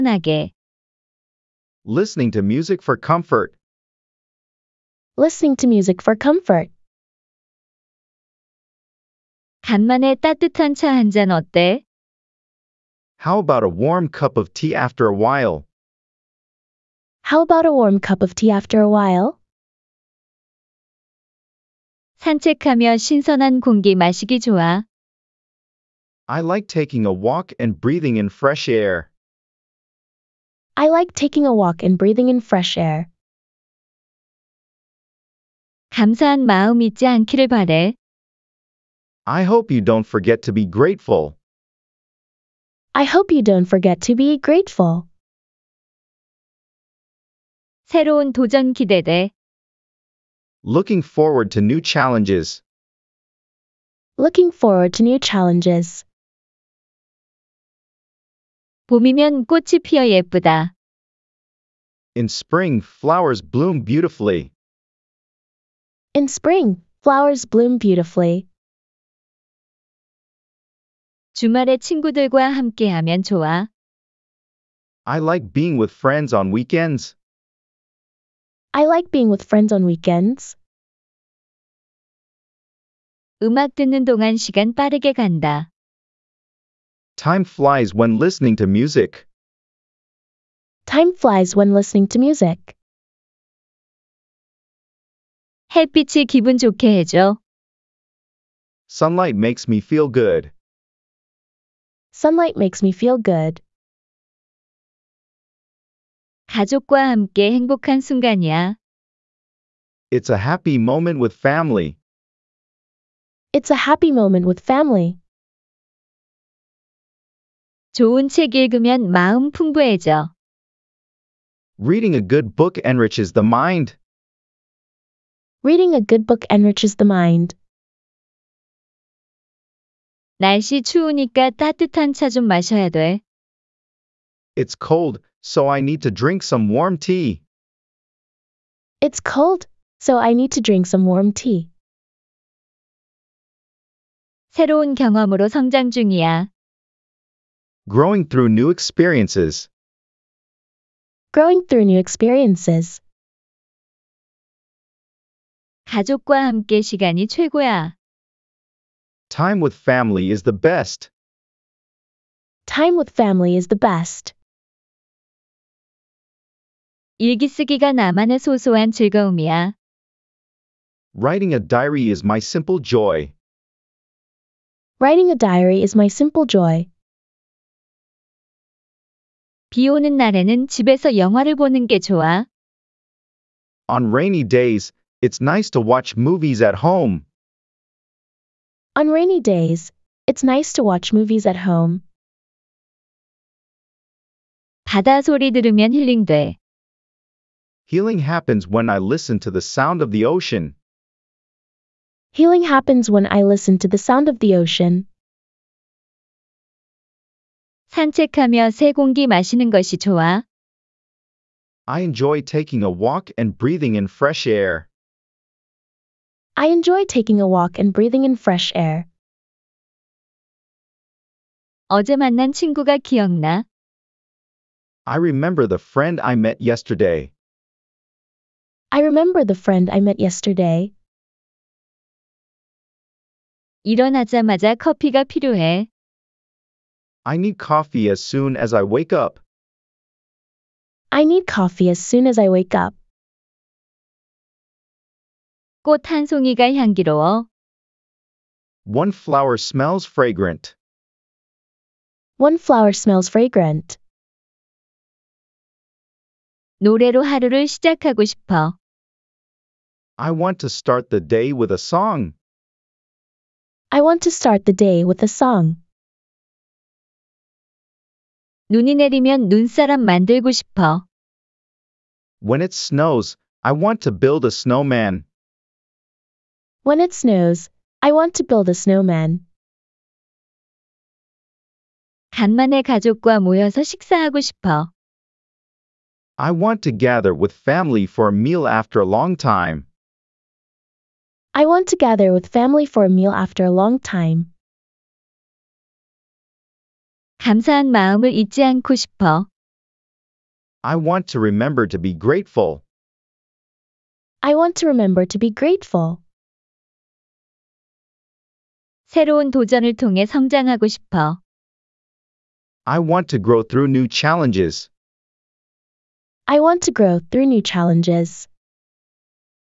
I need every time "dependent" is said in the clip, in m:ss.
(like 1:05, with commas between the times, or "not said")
not said.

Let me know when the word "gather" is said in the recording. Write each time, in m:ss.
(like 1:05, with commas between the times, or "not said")
4:46, 4:51.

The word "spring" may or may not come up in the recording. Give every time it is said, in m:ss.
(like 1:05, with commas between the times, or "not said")
1:02, 1:06.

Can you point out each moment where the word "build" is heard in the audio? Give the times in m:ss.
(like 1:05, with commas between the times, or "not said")
4:34, 4:38.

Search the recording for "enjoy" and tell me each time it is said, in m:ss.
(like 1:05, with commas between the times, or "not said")
3:32, 3:36.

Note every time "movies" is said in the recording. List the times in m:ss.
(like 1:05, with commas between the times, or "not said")
3:06, 3:11.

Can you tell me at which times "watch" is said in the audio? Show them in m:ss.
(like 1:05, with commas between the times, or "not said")
3:05, 3:10.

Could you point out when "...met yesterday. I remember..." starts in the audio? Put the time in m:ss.
3:46.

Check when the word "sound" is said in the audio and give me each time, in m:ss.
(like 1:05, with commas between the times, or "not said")
3:19, 3:24.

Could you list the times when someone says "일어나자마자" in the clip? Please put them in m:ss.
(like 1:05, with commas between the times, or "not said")
3:53.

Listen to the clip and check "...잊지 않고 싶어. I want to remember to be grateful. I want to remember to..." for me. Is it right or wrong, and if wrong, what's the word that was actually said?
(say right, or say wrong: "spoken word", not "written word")
right.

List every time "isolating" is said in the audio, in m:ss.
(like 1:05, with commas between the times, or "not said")
not said.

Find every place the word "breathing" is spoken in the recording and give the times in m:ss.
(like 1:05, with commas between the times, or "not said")
0:27, 0:31, 3:33, 3:37.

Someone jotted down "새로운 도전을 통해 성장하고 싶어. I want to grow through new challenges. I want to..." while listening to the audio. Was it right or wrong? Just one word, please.
right.